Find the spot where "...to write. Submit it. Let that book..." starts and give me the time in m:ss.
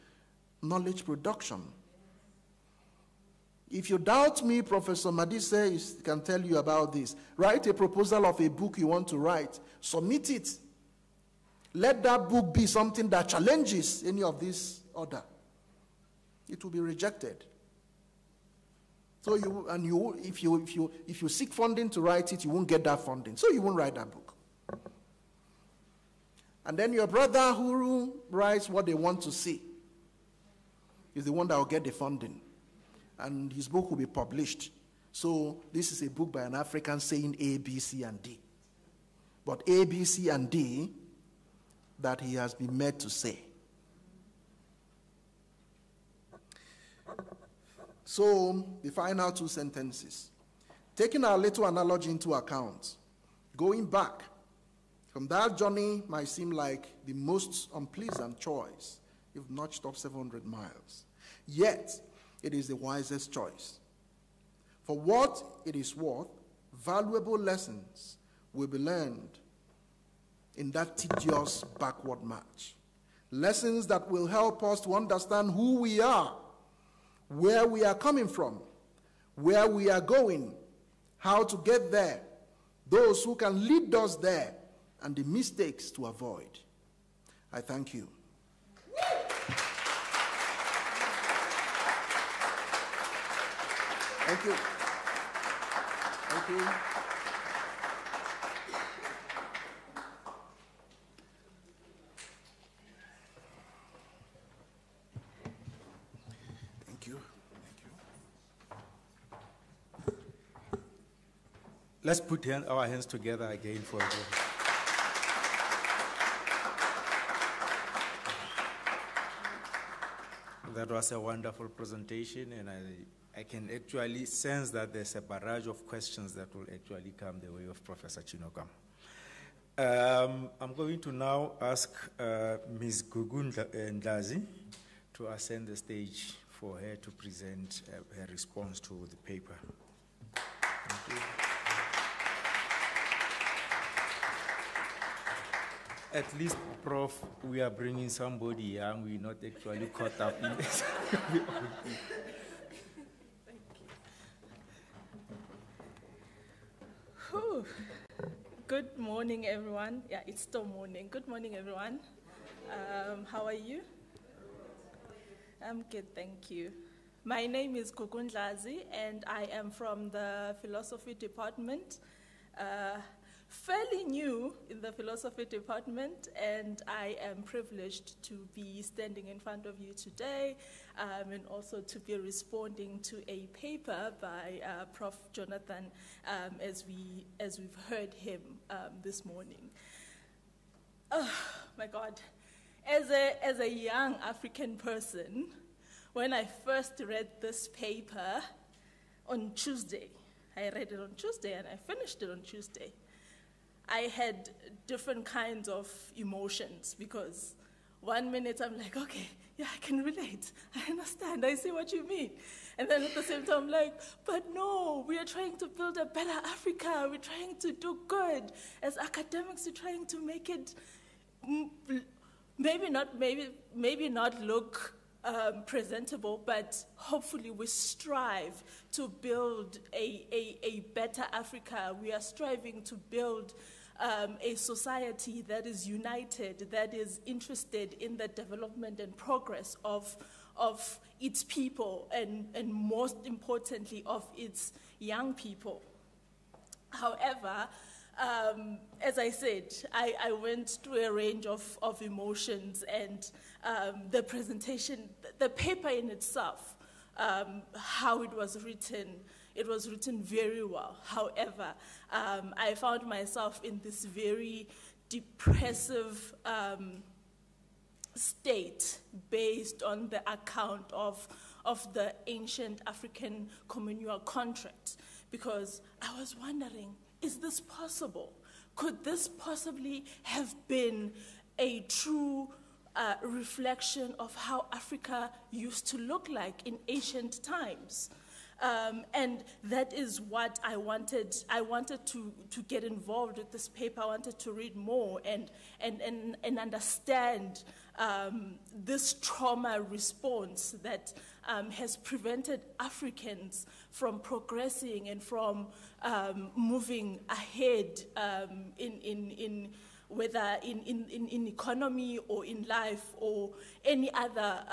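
0:09.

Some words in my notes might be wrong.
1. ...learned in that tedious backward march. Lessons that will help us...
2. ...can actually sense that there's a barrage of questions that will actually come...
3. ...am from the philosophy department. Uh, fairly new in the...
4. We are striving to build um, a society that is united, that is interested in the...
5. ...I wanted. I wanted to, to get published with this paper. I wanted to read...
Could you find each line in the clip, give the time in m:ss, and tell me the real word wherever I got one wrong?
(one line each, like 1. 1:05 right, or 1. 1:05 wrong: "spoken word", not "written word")
1. 1:08 right
2. 2:03 right
3. 2:49 right
4. 3:51 right
5. 4:50 wrong: "involved", not "published".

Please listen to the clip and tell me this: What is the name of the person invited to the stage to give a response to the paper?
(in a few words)
Gugun Ndazi.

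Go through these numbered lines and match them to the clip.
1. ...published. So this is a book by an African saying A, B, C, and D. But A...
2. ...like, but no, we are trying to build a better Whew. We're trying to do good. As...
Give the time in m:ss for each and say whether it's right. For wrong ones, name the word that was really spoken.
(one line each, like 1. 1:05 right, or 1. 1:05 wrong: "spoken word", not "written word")
1. 0:34 right
2. 3:33 wrong: "Africa", not "Whew".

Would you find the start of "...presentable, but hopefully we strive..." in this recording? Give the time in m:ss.
3:45.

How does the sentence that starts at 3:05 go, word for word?
Jonathan um, as, we, as we've heard him um, this morning.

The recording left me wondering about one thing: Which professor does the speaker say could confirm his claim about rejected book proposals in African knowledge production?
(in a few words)
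Professor Madise.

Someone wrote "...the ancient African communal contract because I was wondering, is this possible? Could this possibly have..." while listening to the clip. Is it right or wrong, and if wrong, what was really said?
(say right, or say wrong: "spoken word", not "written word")
right.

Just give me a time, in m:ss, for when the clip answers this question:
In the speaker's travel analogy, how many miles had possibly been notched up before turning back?
0:59.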